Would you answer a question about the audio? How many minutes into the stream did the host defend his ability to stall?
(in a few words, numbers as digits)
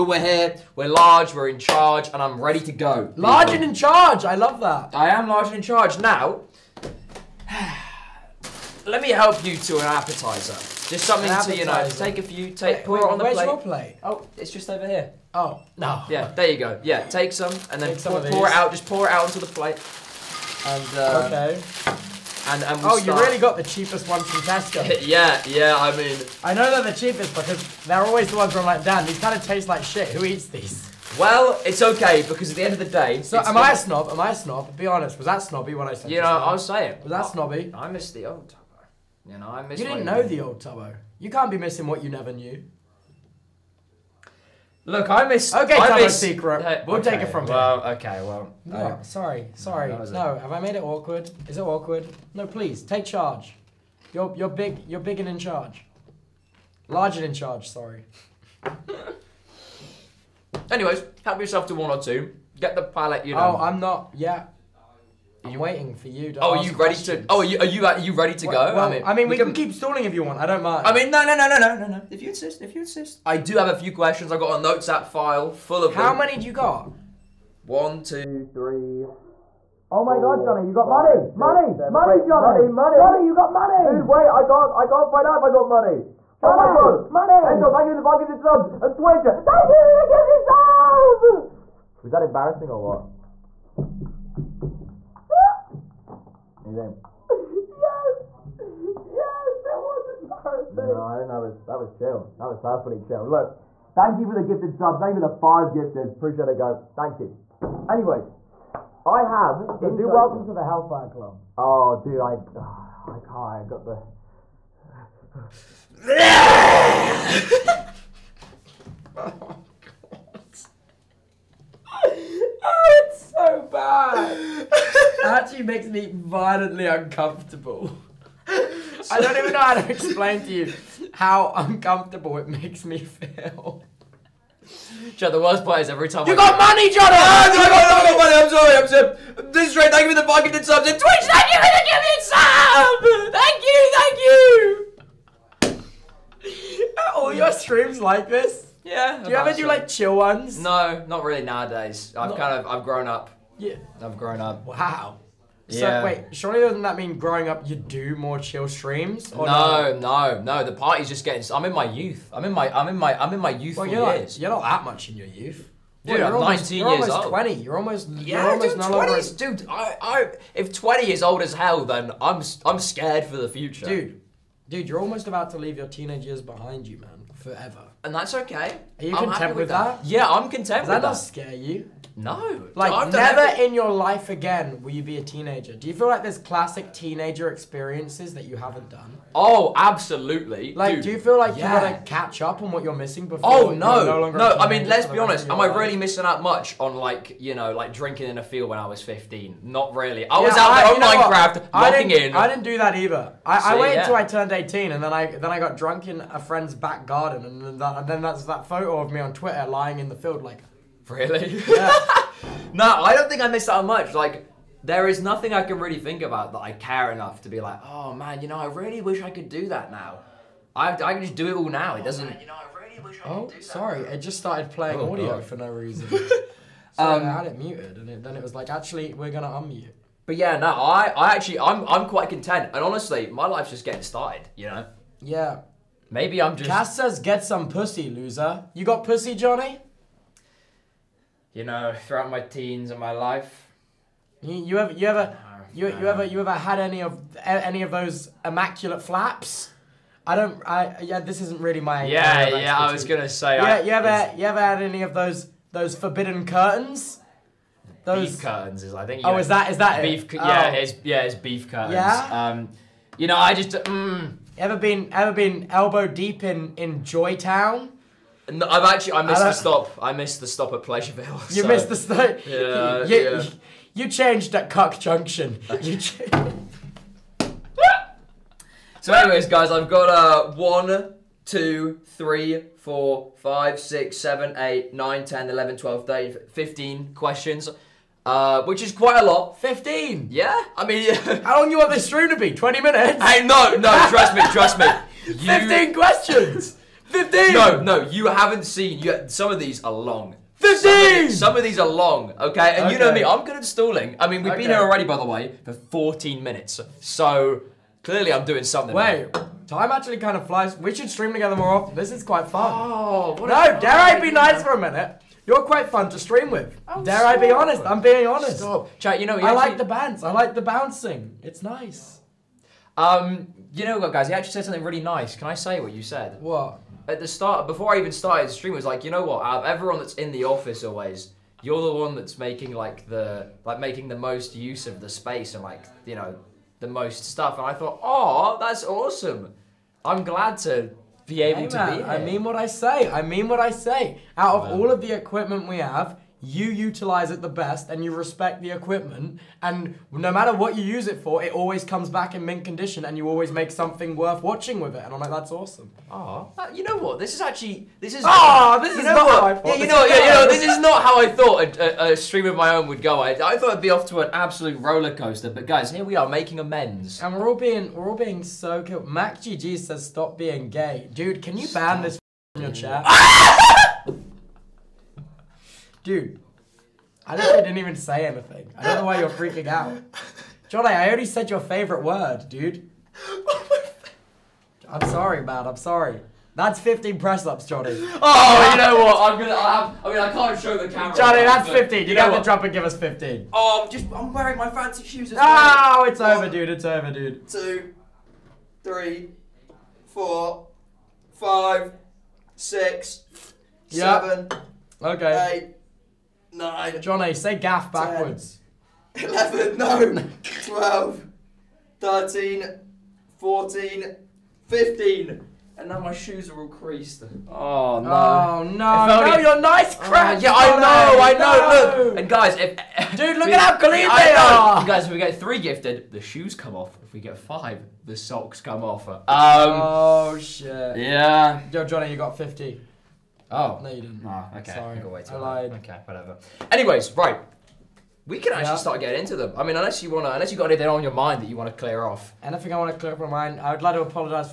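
14.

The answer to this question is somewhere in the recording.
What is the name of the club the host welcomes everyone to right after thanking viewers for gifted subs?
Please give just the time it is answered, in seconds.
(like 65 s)
110 s.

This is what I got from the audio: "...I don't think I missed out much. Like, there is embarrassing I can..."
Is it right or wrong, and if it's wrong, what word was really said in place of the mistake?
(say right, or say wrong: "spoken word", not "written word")
wrong: "nothing", not "embarrassing".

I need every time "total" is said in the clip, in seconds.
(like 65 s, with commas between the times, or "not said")
110 s.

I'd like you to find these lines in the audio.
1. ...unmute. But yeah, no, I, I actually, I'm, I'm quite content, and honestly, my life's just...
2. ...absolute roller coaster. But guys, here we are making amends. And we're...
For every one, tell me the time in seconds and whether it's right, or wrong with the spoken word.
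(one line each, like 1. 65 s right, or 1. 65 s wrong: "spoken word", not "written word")
1. 229 s right
2. 364 s right.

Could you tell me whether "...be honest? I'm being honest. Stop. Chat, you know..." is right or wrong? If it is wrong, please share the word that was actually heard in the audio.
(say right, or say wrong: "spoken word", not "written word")
right.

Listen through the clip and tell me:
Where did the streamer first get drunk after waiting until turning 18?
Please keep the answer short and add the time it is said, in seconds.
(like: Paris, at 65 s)
A friend's back garden, at 206 s.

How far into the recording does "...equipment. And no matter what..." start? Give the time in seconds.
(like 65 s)
348 s.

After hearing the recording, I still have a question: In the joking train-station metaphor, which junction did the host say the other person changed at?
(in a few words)
Cuck Junction.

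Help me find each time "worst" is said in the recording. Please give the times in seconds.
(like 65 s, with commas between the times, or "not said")
135 s.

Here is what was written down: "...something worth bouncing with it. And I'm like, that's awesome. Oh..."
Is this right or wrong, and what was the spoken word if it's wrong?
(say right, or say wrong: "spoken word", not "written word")
wrong: "watching", not "bouncing".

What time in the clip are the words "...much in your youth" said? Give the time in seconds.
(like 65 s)
164 s.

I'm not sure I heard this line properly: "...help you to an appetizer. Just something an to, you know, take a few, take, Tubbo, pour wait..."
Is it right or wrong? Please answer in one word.
wrong.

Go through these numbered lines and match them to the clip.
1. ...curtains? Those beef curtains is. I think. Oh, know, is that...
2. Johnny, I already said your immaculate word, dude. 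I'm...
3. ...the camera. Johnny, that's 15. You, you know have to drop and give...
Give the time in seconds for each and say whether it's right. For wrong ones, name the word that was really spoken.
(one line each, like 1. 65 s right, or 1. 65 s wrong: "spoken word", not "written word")
1. 256 s right
2. 380 s wrong: "favorite", not "immaculate"
3. 390 s right.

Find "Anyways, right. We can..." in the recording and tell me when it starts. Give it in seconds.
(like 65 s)
436 s.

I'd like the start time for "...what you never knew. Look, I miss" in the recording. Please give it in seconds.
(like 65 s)
41 s.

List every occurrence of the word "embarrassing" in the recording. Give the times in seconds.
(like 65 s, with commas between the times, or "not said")
92 s, 100 s.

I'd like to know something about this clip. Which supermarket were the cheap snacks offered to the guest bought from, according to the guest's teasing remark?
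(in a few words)
Tesco.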